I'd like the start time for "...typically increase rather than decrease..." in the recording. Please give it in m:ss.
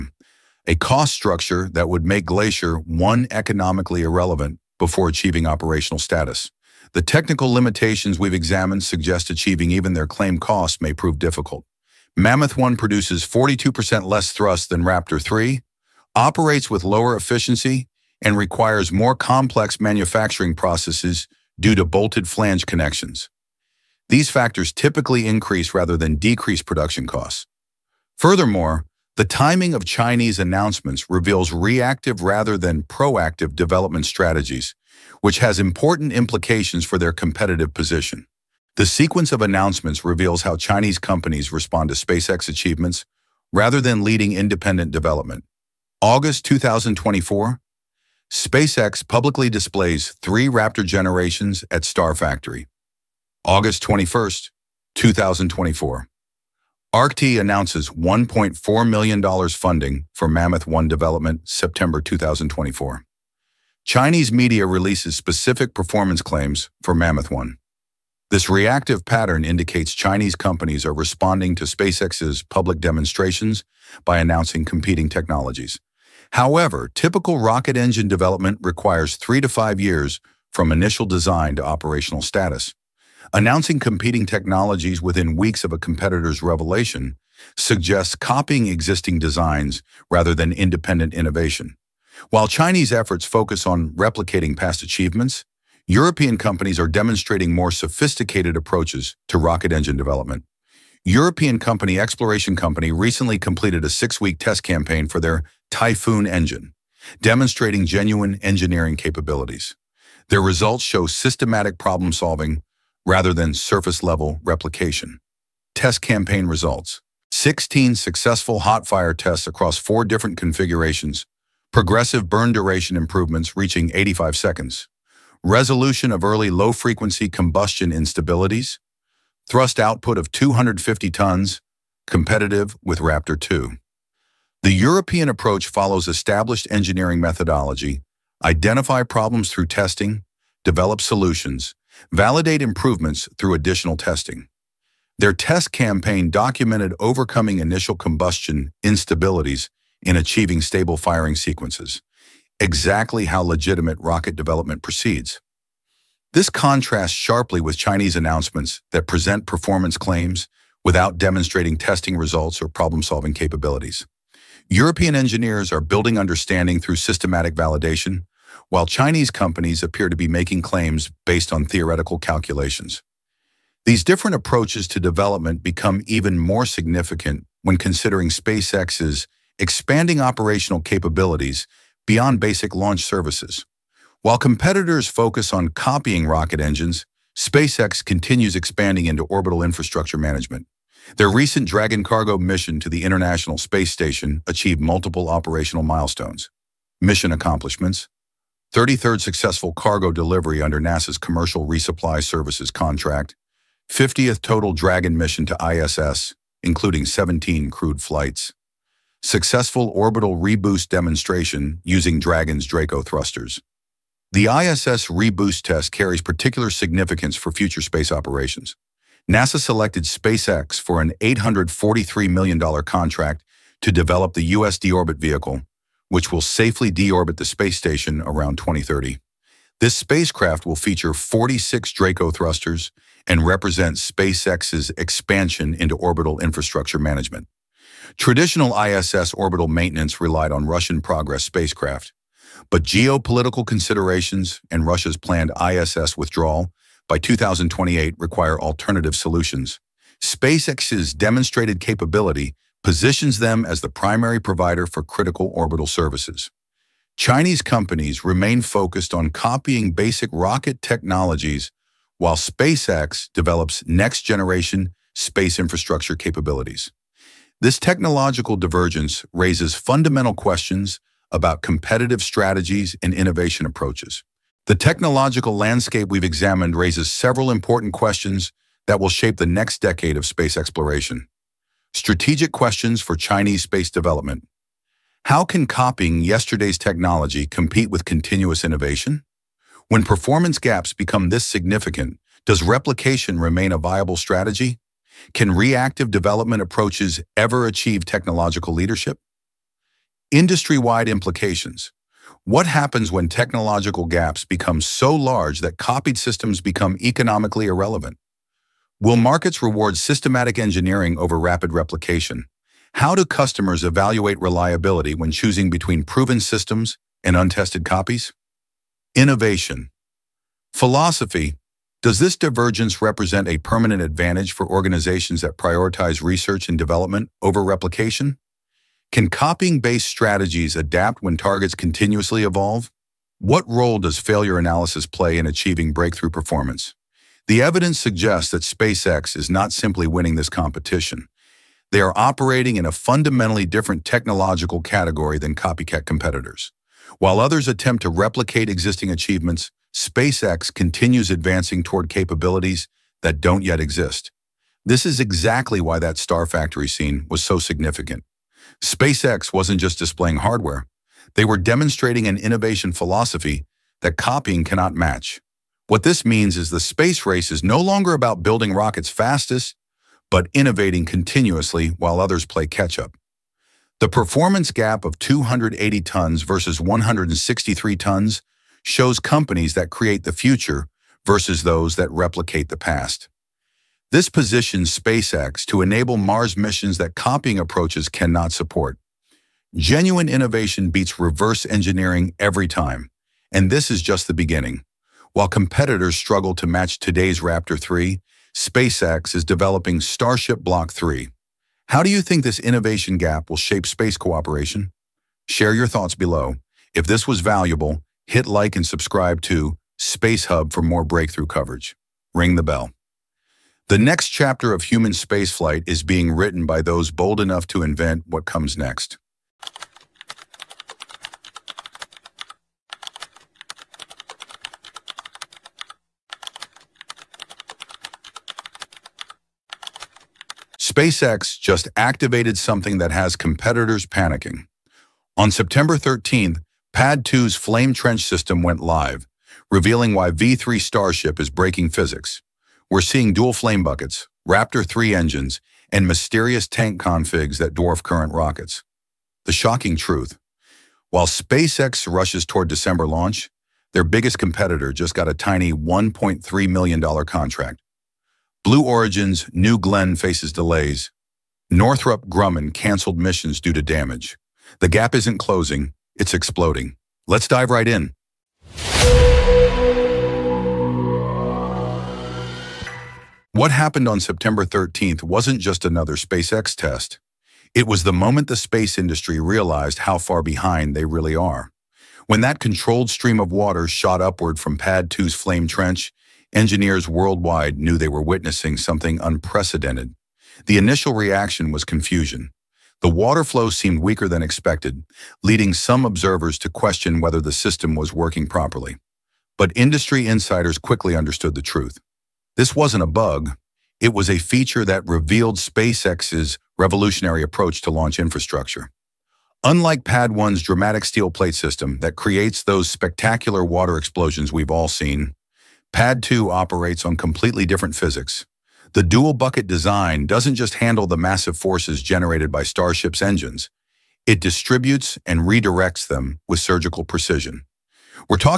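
0:24.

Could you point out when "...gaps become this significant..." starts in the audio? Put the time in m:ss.
4:50.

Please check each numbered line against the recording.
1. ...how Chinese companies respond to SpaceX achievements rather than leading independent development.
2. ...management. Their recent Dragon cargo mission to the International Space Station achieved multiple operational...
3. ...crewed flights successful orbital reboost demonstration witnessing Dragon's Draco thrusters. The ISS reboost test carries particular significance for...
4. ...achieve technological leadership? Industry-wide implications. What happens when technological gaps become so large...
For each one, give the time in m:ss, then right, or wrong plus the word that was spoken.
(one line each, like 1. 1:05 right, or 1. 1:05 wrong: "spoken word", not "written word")
1. 0:40 right
2. 3:10 right
3. 3:27 wrong: "using", not "witnessing"
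4. 4:57 right.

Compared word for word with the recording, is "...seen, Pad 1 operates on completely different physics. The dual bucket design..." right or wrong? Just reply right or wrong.
wrong.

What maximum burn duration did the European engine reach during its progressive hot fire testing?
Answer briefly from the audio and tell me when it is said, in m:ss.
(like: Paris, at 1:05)
85 seconds, at 2:03.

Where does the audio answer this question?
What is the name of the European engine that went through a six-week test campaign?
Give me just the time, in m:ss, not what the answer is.
1:45.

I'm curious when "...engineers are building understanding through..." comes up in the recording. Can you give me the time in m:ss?
2:45.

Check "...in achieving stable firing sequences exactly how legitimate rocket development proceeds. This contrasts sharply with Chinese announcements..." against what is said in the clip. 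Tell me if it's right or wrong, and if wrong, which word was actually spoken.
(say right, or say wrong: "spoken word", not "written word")
right.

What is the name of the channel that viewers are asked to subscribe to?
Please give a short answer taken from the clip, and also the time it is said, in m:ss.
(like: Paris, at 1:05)
Space Hub, at 6:49.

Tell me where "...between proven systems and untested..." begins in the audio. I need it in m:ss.
5:15.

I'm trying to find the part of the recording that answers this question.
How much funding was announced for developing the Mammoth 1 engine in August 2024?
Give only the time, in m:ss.
0:57.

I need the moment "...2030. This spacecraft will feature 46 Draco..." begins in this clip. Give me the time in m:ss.
3:48.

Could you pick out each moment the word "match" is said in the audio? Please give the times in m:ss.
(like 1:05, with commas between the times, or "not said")
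6:04, 6:36.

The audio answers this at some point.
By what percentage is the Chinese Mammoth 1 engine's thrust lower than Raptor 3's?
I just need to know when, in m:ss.
0:13.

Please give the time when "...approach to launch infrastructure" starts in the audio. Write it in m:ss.
8:27.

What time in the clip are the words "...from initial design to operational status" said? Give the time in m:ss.
1:20.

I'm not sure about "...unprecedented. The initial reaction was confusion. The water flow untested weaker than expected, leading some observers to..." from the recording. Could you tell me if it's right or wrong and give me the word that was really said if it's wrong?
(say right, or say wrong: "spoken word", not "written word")
wrong: "seemed", not "untested".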